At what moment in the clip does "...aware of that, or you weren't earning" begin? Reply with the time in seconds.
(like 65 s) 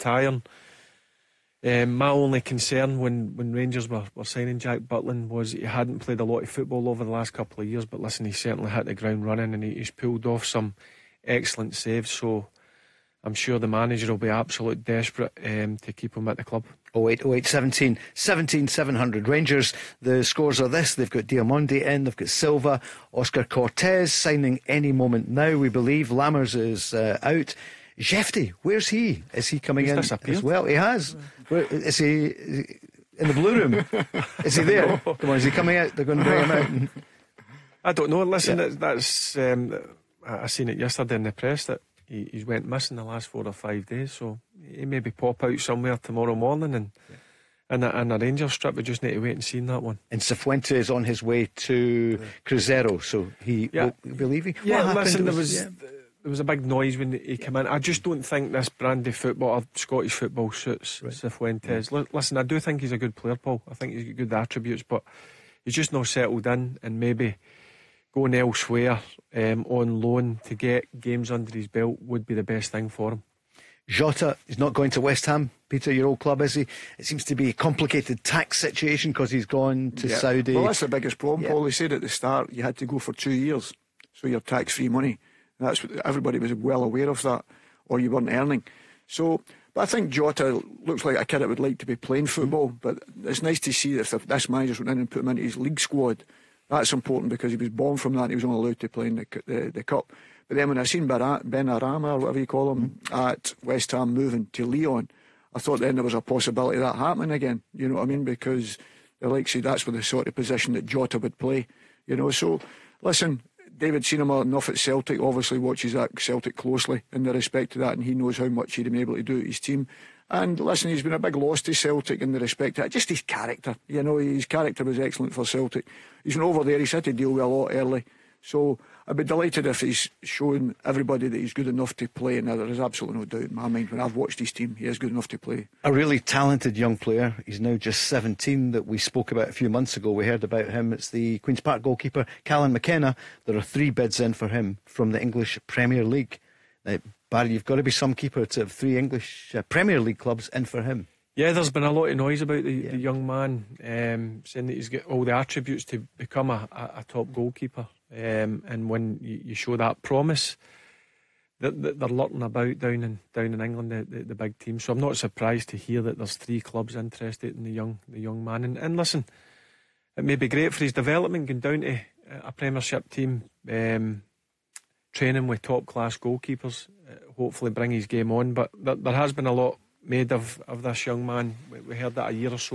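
86 s.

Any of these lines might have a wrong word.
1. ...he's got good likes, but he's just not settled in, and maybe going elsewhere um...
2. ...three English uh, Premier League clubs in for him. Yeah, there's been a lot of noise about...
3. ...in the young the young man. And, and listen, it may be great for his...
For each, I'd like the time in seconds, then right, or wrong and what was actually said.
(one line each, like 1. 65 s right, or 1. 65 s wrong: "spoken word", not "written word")
1. 63 s wrong: "attributes", not "likes"
2. 148 s right
3. 167 s right.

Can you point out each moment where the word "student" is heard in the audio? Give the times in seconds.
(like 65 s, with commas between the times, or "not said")
not said.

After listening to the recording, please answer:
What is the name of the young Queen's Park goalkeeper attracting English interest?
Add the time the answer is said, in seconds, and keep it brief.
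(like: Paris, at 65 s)
Callan McKenna, at 142 s.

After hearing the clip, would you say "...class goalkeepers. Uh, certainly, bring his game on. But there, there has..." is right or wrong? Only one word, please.
wrong.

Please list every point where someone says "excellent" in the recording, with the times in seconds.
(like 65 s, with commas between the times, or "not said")
11 s, 124 s.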